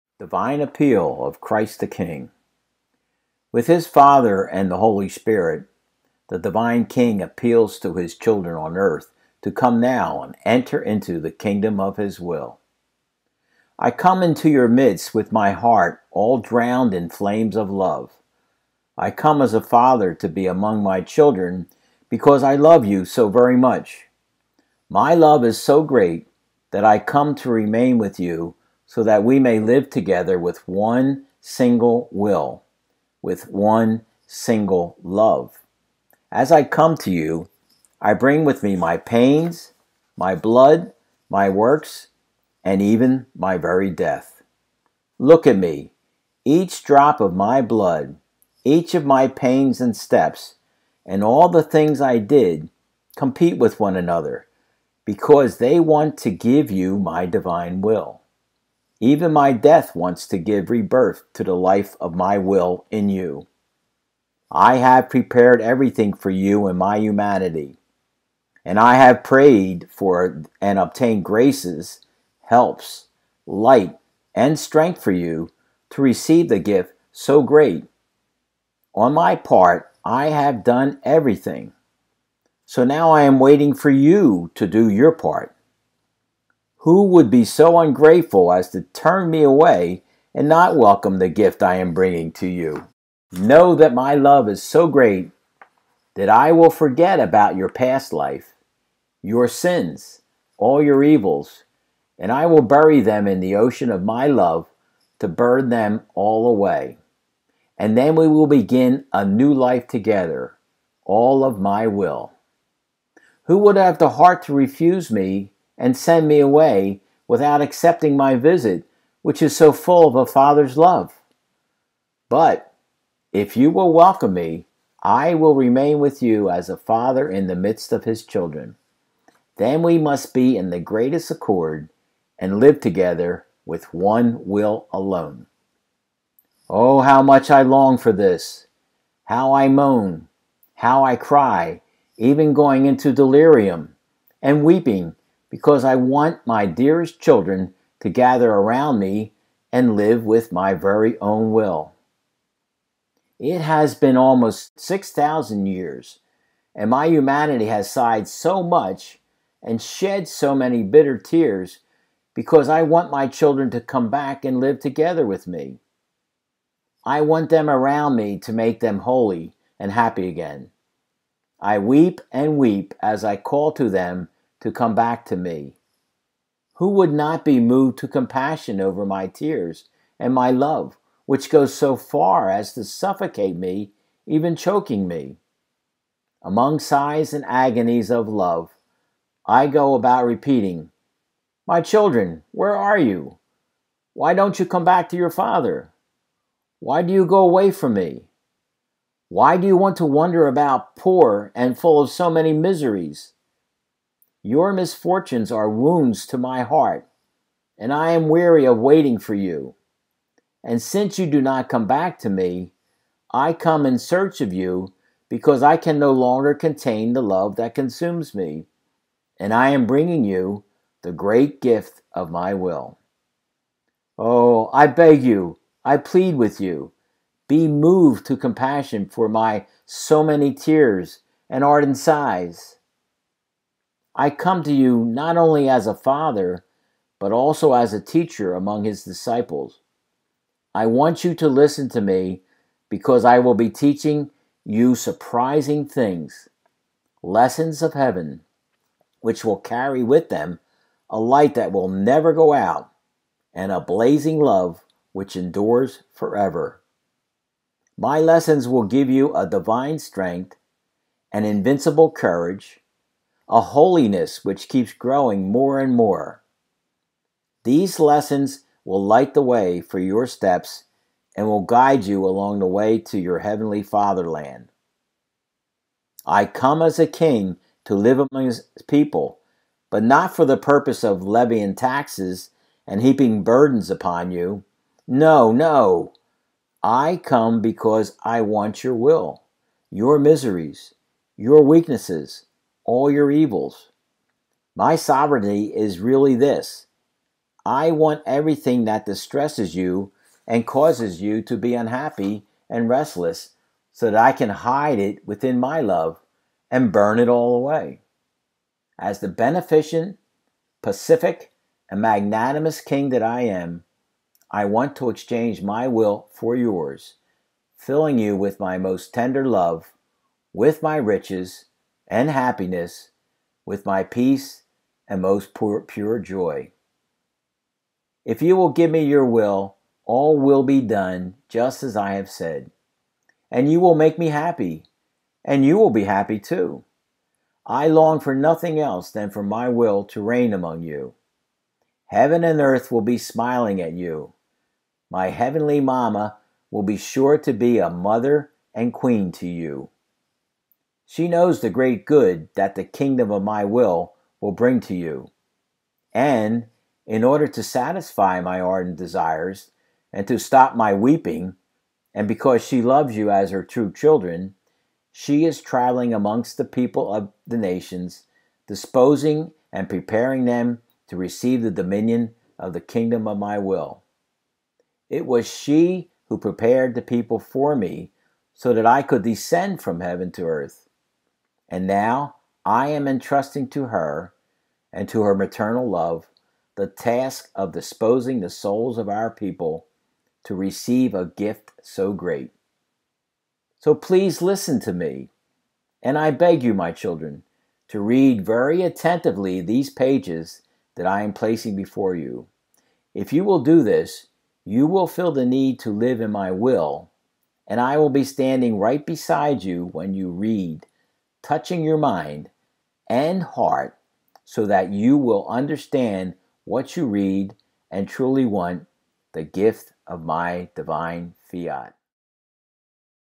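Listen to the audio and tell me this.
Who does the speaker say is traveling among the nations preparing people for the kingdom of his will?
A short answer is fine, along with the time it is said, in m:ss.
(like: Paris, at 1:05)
my heavenly mamma, at 5:45.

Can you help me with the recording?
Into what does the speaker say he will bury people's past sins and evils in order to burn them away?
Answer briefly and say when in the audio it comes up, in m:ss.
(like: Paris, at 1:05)
the ocean of my love, at 1:43.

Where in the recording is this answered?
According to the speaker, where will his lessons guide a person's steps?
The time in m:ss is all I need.
4:33.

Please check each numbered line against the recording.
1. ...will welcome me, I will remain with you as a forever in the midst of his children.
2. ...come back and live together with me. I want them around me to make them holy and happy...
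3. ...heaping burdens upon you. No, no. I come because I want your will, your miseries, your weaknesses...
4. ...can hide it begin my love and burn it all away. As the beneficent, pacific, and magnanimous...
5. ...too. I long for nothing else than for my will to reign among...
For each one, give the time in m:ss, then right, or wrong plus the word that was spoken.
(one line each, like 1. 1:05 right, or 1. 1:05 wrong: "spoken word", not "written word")
1. 2:03 wrong: "father", not "forever"
2. 2:43 right
3. 4:43 right
4. 5:04 wrong: "within", not "begin"
5. 5:36 right.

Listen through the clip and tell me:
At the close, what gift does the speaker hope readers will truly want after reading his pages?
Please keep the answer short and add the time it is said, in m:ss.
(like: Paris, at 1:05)
divine fiat, at 7:00.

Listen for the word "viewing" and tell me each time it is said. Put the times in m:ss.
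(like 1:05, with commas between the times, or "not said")
not said.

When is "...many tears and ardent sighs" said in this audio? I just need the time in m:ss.
3:50.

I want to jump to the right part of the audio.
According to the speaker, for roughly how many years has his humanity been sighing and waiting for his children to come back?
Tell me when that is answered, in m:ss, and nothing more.
2:34.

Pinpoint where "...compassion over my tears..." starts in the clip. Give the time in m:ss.
2:58.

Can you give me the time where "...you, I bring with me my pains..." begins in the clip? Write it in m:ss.
0:37.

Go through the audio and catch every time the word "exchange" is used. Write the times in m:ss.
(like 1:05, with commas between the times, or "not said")
5:15.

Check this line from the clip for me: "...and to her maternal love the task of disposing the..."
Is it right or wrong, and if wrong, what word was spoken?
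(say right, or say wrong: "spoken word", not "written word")
right.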